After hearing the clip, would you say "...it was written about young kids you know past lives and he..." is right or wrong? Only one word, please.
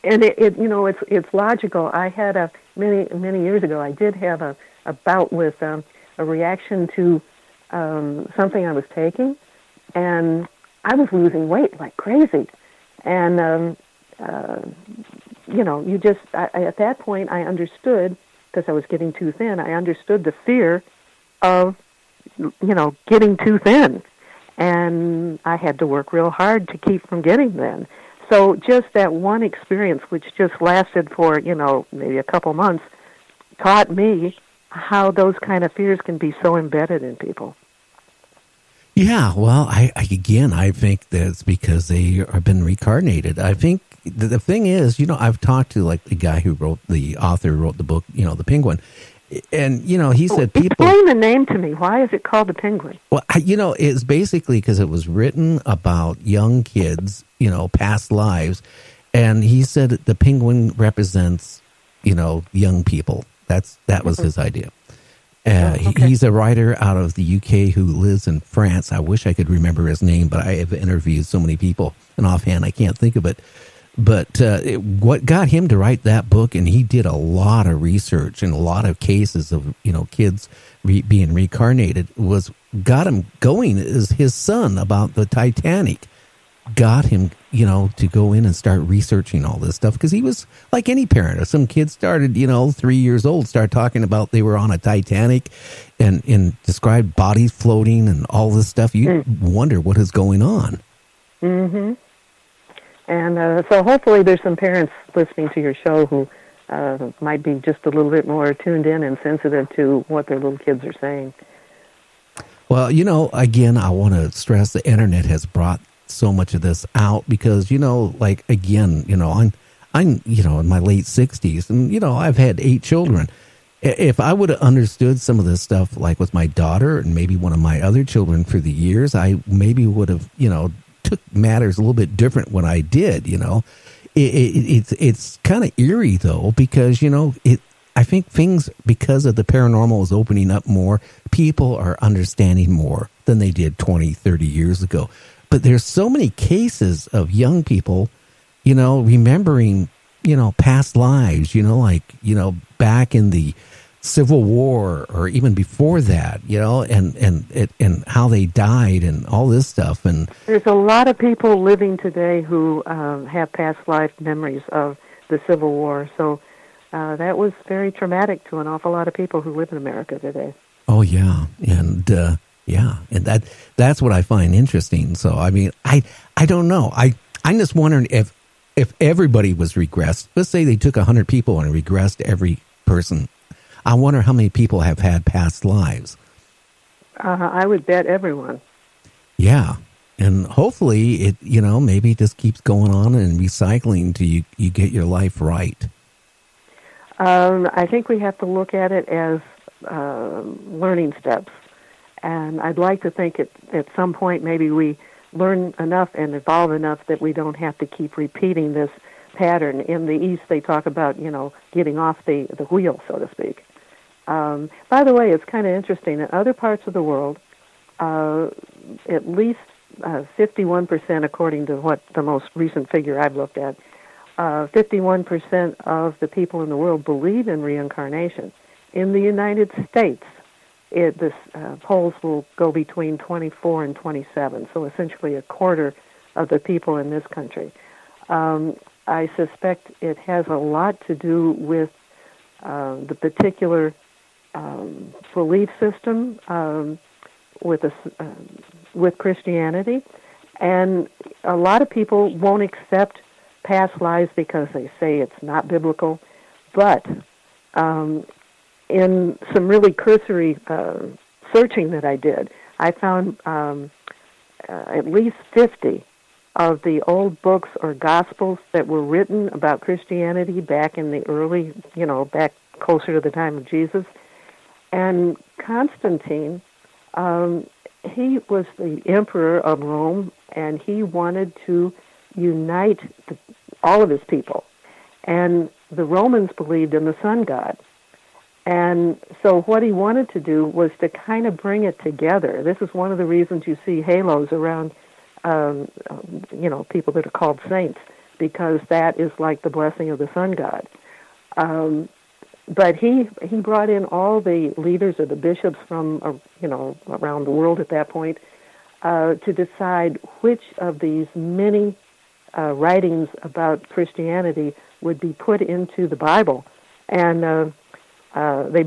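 right.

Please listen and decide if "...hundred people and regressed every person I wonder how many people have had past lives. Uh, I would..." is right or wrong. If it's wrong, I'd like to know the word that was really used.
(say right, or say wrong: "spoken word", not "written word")
right.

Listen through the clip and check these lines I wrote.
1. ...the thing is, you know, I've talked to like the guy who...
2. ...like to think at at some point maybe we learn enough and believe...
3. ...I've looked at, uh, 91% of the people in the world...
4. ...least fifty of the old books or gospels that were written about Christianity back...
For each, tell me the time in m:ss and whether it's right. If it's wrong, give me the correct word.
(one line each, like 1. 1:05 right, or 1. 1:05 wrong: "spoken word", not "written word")
1. 0:44 right
2. 3:22 wrong: "evolve", not "believe"
3. 3:43 wrong: "51", not "91"
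4. 4:25 right.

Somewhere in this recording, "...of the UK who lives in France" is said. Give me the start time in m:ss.
1:06.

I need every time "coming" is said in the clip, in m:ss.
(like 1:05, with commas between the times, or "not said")
not said.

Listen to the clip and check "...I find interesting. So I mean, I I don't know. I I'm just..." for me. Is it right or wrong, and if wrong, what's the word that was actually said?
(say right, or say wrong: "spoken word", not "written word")
right.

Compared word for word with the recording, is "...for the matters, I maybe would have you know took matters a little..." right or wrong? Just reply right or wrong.
wrong.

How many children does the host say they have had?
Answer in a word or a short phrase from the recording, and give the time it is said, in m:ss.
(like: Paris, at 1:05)
8, at 2:02.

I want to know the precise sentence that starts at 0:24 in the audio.
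And I had to work real hard to keep from getting thin.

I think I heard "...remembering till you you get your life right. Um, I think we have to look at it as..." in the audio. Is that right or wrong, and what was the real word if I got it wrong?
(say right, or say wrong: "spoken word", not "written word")
wrong: "recycling", not "remembering".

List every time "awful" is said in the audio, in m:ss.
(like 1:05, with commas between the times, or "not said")
2:48.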